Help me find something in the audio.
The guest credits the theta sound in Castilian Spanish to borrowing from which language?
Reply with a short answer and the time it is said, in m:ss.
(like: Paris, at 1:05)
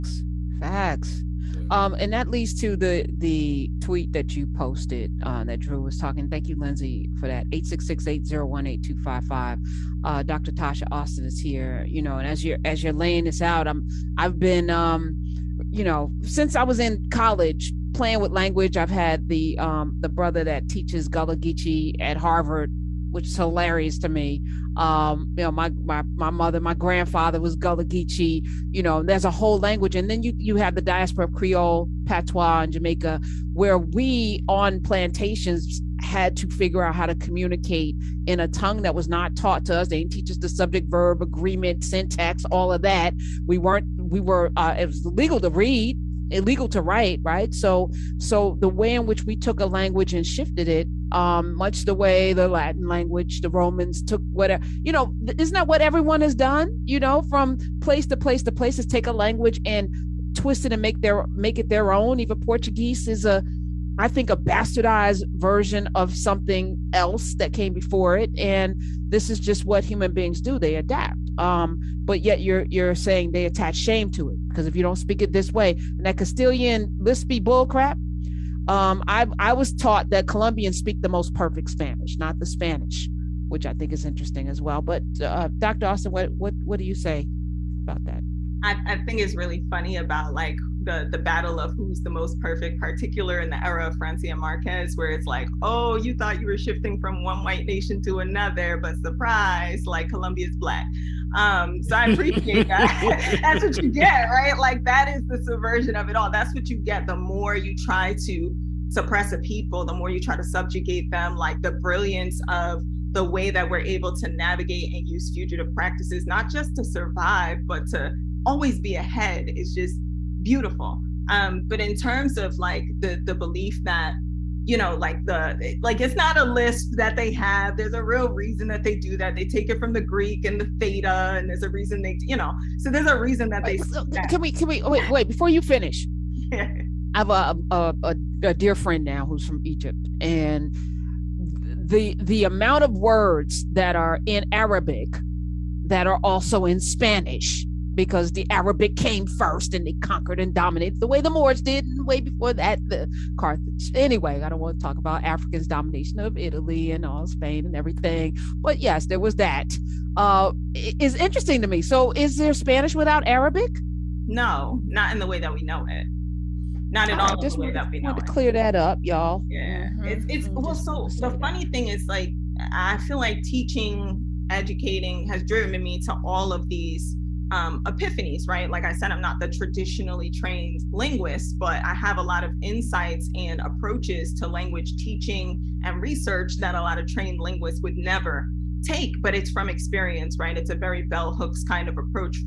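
Greek, at 2:09.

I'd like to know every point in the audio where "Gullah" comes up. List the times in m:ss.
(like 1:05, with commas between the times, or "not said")
0:21, 0:27.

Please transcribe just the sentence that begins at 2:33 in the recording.
Anyway, I don't want to talk about Africans' domination of Italy and all Spain and everything, but yes, there was that.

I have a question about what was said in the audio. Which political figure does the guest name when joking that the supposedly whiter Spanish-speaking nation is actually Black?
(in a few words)
Francia Marquez.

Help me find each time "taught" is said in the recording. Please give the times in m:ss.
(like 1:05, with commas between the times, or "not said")
0:39, 1:19.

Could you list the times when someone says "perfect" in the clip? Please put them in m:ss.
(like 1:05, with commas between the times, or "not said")
1:21, 1:32.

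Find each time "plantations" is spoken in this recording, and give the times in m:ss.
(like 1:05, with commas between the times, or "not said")
0:34.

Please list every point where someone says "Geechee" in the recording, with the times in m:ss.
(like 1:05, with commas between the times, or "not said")
0:21, 0:27.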